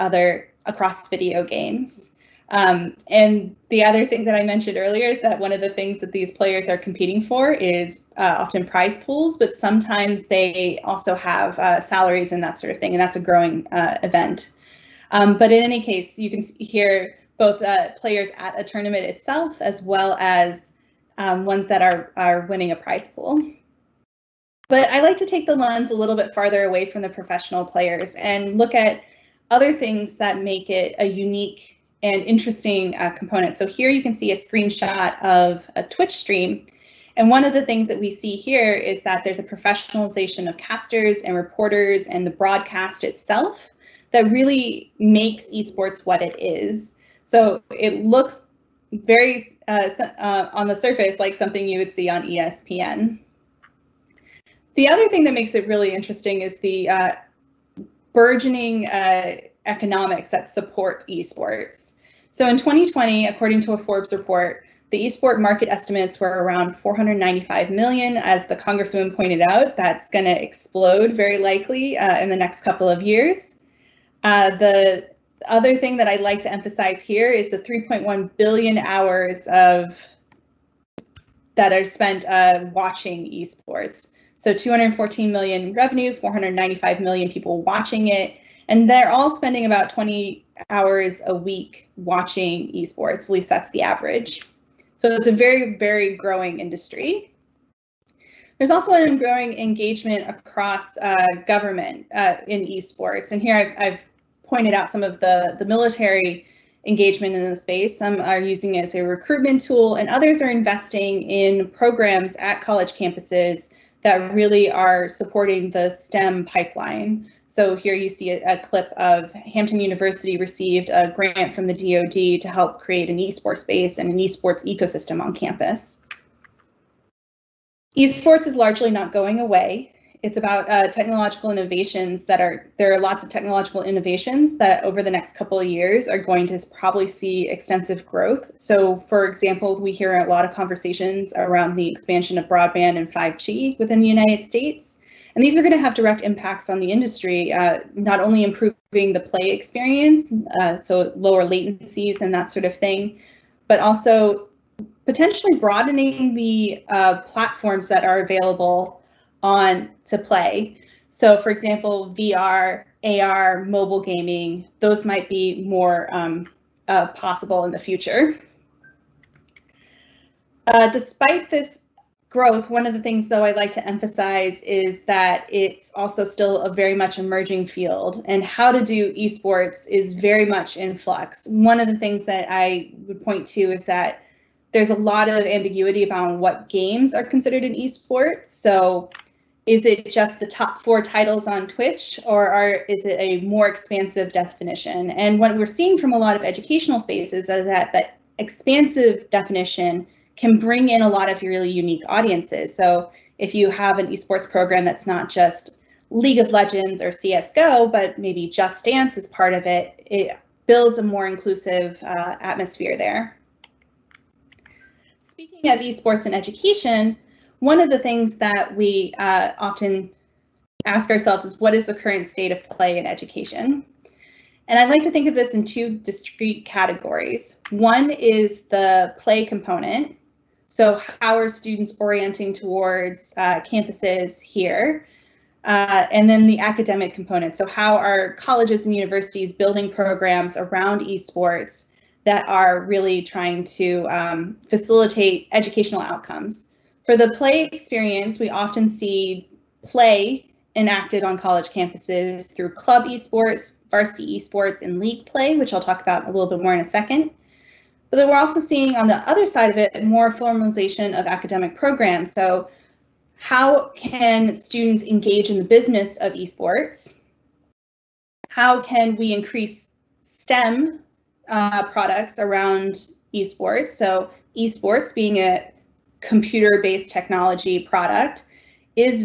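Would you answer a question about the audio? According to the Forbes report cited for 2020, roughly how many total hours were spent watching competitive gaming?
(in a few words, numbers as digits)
3.1 billion.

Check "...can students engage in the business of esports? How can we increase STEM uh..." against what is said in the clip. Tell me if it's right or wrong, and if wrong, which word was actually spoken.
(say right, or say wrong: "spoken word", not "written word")
right.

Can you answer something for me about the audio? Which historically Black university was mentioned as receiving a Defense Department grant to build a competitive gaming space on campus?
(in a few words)
Hampton University.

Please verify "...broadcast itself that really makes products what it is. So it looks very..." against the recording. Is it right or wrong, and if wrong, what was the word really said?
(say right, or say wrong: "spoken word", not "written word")
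wrong: "esports", not "products".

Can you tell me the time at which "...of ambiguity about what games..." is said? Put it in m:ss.
3:05.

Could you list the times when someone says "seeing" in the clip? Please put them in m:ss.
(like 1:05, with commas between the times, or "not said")
3:15, 4:18.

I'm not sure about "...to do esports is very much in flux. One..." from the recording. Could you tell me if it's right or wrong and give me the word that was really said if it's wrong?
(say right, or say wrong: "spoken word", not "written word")
right.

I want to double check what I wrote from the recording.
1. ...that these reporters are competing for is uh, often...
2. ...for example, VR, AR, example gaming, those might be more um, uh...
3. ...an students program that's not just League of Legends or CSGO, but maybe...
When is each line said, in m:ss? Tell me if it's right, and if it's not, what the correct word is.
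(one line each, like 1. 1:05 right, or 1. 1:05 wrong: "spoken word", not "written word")
1. 0:06 wrong: "players", not "reporters"
2. 2:41 wrong: "mobile", not "example"
3. 3:23 wrong: "esports", not "students".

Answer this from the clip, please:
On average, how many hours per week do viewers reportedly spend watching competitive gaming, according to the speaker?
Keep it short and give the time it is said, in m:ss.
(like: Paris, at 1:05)
20 hours, at 1:29.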